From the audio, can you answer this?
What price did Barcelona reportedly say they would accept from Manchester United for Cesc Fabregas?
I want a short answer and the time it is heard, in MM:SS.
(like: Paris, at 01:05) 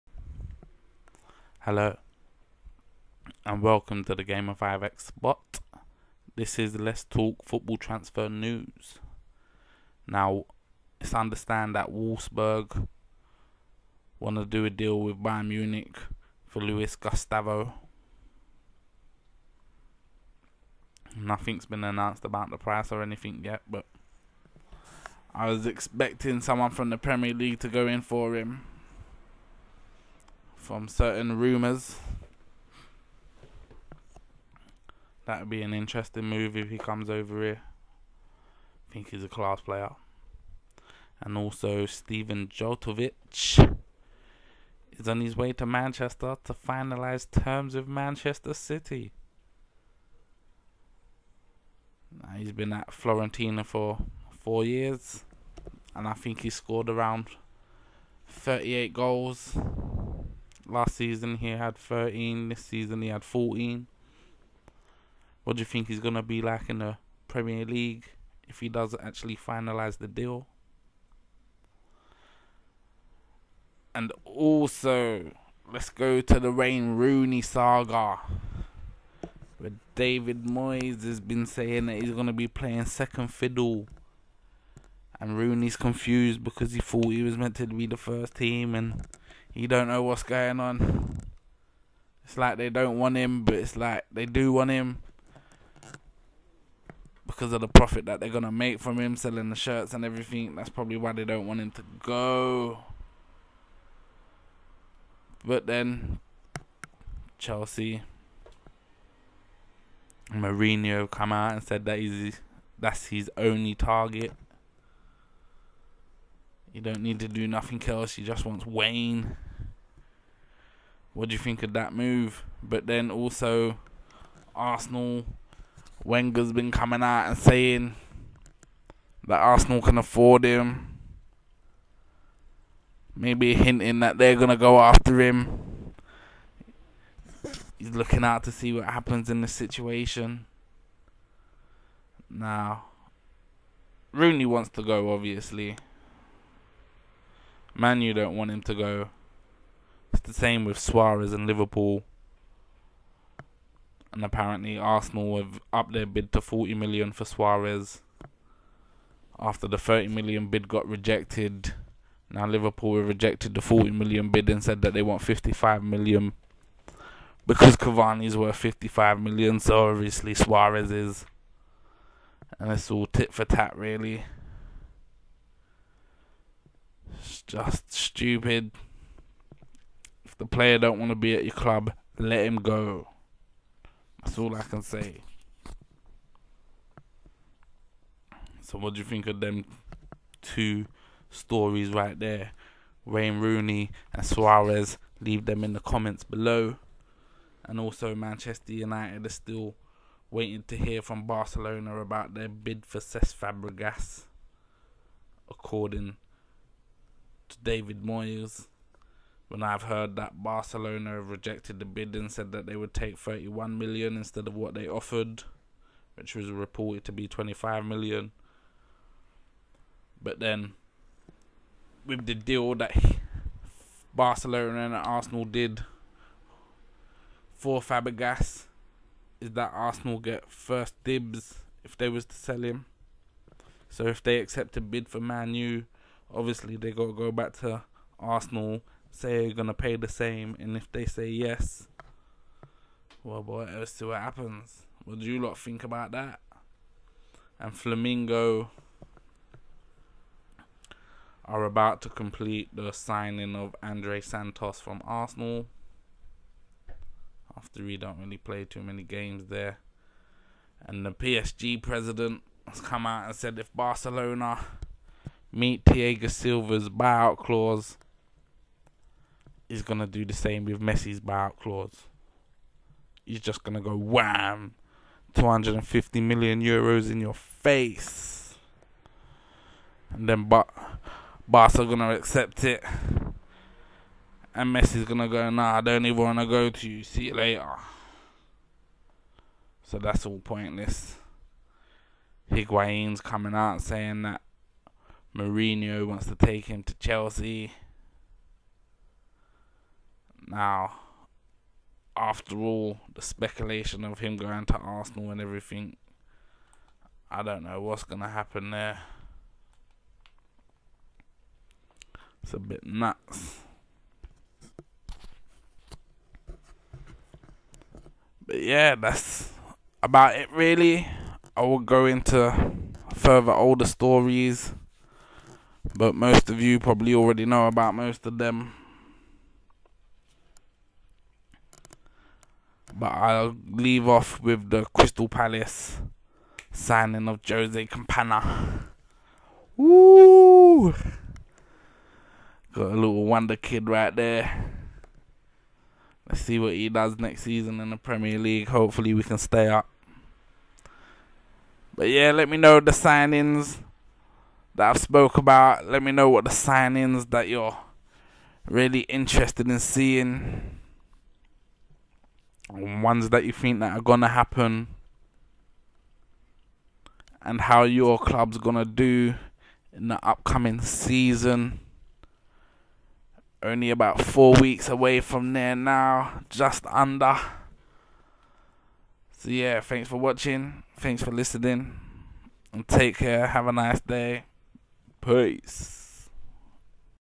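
31 million, at 03:33.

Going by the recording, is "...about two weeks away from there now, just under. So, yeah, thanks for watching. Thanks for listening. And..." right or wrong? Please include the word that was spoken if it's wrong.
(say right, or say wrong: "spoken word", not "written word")
wrong: "four", not "two".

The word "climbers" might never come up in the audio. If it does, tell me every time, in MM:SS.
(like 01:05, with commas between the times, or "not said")
not said.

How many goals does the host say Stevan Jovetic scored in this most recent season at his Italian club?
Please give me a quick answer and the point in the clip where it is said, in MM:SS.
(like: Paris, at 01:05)
14, at 01:03.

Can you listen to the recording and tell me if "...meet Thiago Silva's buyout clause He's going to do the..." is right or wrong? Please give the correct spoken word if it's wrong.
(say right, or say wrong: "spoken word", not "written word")
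right.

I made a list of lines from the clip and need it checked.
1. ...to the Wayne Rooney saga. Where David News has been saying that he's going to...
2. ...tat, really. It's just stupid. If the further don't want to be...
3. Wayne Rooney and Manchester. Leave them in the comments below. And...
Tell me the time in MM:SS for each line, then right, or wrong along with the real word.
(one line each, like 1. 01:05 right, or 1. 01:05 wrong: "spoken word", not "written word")
1. 01:16 wrong: "Moyes", not "News"
2. 02:53 wrong: "player", not "further"
3. 03:13 wrong: "Suarez", not "Manchester".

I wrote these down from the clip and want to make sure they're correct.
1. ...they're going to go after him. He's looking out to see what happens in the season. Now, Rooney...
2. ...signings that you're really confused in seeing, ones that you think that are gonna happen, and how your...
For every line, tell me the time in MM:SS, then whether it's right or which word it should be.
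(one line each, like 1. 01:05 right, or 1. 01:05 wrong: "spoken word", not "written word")
1. 02:14 wrong: "situation", not "season"
2. 05:56 wrong: "interested", not "confused".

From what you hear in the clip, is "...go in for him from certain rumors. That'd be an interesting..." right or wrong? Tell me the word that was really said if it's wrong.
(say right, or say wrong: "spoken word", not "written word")
right.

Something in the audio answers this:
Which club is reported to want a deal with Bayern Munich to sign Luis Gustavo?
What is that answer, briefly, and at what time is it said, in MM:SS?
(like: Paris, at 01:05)
Wolfsburg, at 00:11.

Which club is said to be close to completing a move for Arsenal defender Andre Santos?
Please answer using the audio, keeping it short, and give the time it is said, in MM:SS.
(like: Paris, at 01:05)
Flamengo, at 04:07.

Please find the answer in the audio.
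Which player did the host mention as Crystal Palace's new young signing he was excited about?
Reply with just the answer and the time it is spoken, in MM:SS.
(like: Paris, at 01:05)
Jose Campana, at 05:37.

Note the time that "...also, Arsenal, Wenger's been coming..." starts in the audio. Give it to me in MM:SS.
02:03.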